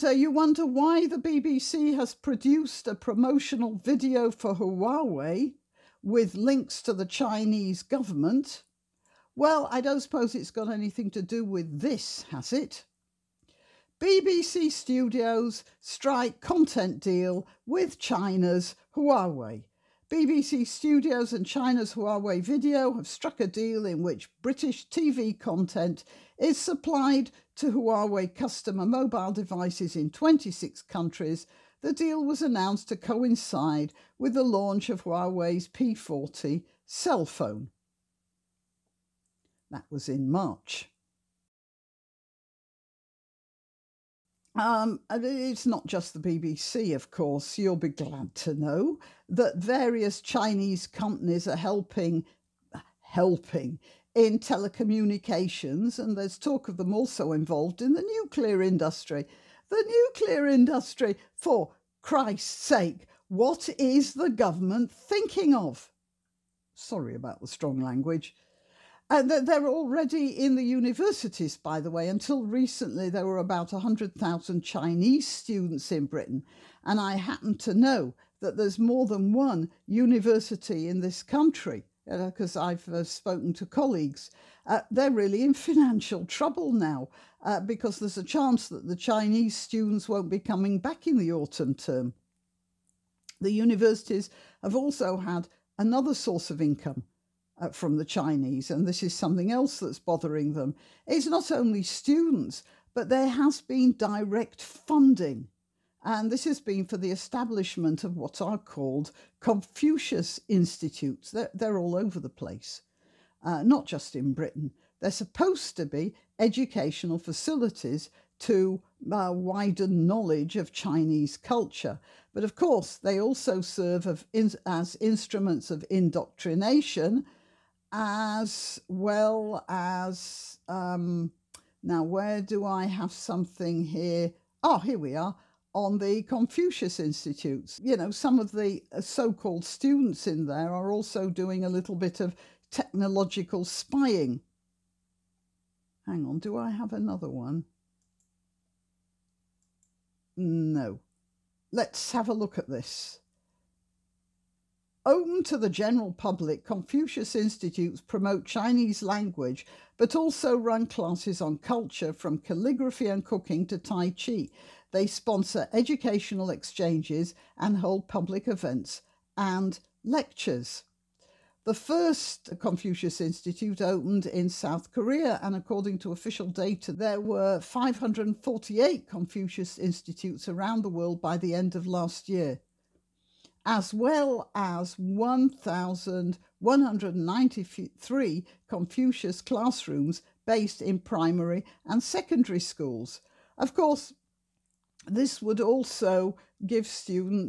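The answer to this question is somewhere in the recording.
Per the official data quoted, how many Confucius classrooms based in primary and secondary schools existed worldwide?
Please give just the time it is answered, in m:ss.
3:04.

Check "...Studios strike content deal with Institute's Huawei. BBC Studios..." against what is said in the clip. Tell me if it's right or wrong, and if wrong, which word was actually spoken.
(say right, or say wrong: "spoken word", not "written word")
wrong: "China", not "Institute".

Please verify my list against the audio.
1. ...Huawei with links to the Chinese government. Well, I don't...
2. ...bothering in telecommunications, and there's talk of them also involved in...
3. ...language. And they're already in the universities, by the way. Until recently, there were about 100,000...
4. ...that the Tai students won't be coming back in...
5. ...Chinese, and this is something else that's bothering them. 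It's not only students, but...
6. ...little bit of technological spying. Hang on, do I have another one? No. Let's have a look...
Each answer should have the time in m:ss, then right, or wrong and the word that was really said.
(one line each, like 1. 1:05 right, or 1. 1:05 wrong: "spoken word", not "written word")
1. 0:04 right
2. 0:52 wrong: "helping", not "bothering"
3. 1:07 right
4. 1:28 wrong: "Chinese", not "Tai"
5. 1:38 right
6. 2:21 right.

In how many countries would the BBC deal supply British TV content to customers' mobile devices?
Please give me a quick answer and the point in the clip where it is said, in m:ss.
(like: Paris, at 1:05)
26, at 0:30.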